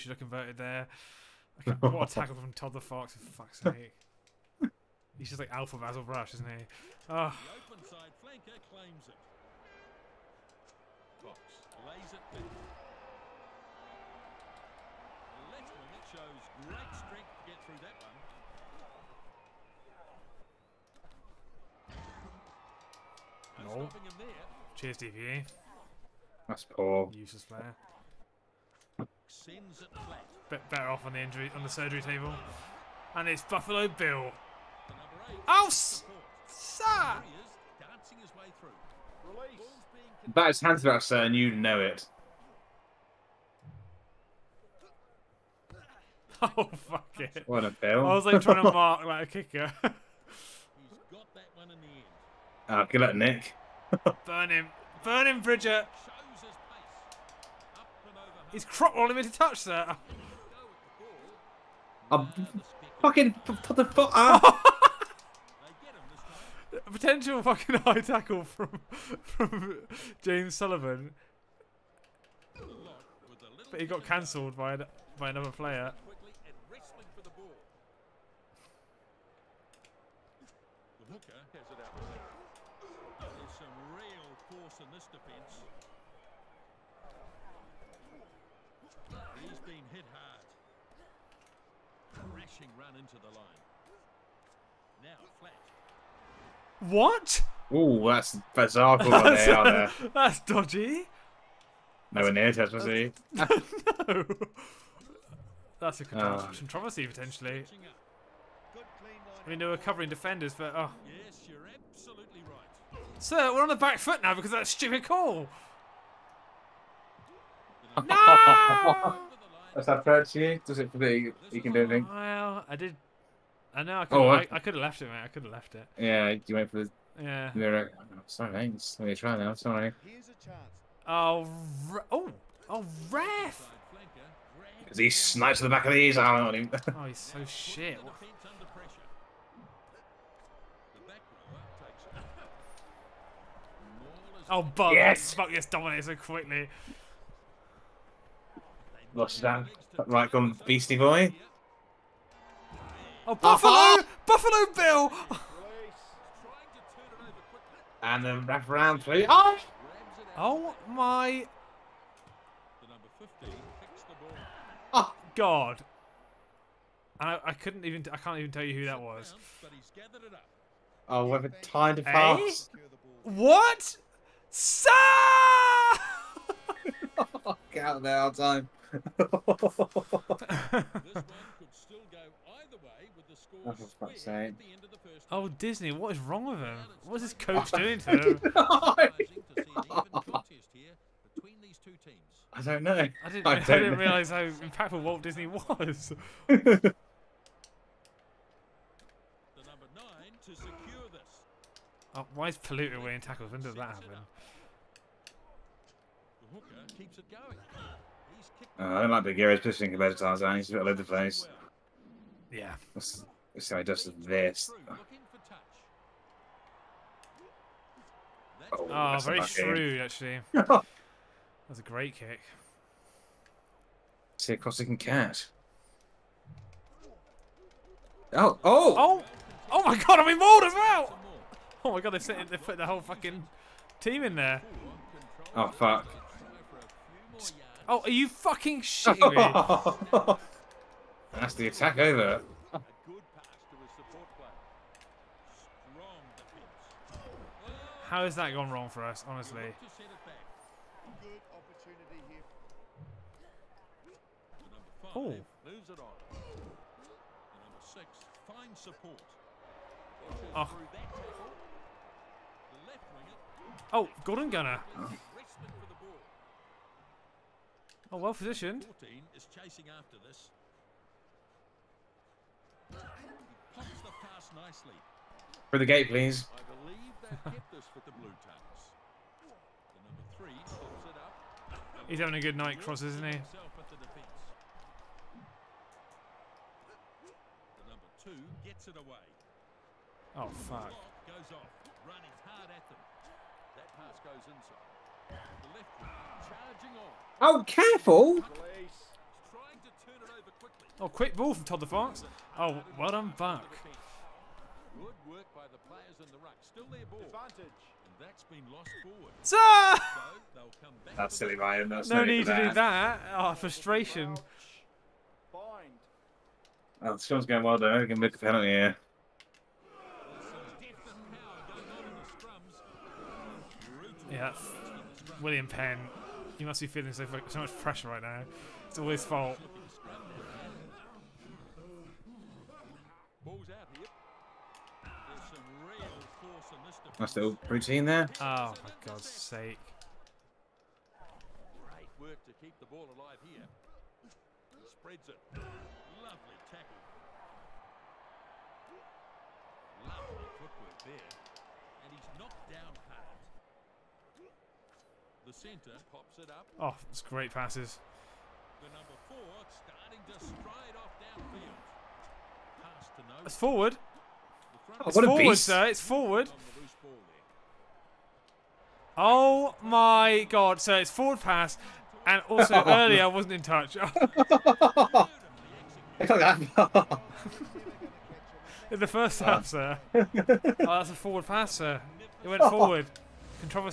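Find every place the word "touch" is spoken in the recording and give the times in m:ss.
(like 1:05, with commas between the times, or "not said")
0:59, 6:13.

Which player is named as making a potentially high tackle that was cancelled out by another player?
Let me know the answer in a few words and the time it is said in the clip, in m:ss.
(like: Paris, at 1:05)
James Sullivan, at 1:10.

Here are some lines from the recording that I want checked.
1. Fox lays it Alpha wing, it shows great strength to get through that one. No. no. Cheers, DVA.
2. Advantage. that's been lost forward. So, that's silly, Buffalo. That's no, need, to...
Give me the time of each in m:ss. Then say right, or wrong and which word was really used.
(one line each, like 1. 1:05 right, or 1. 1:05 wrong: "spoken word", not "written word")
1. 0:11 wrong: "Left", not "Alpha"
2. 5:07 wrong: "Ryan", not "Buffalo".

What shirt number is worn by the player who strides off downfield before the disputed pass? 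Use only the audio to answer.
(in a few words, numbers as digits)
4.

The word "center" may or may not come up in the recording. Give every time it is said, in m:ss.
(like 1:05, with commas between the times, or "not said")
5:55.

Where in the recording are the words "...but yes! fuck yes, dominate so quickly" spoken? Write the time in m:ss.
2:24.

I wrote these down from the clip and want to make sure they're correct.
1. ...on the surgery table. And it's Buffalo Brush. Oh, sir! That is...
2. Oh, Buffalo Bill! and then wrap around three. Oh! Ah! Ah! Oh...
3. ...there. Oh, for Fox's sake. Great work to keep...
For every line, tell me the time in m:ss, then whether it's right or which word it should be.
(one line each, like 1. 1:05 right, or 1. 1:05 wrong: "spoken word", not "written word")
1. 0:31 wrong: "Bill", not "Brush"
2. 2:33 right
3. 5:38 wrong: "God", not "Fox".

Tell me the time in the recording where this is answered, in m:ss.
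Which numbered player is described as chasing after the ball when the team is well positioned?
4:29.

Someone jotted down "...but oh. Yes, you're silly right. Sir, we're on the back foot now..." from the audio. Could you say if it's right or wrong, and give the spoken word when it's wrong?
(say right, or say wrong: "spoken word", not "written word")
wrong: "absolutely", not "silly".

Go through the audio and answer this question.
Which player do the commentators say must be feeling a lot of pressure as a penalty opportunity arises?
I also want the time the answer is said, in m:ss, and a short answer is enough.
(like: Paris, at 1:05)
William Penn, at 5:25.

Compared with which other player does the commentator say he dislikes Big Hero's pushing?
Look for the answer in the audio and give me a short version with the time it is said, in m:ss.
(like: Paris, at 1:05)
Tarzan, at 3:30.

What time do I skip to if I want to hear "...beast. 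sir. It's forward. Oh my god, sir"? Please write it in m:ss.
6:05.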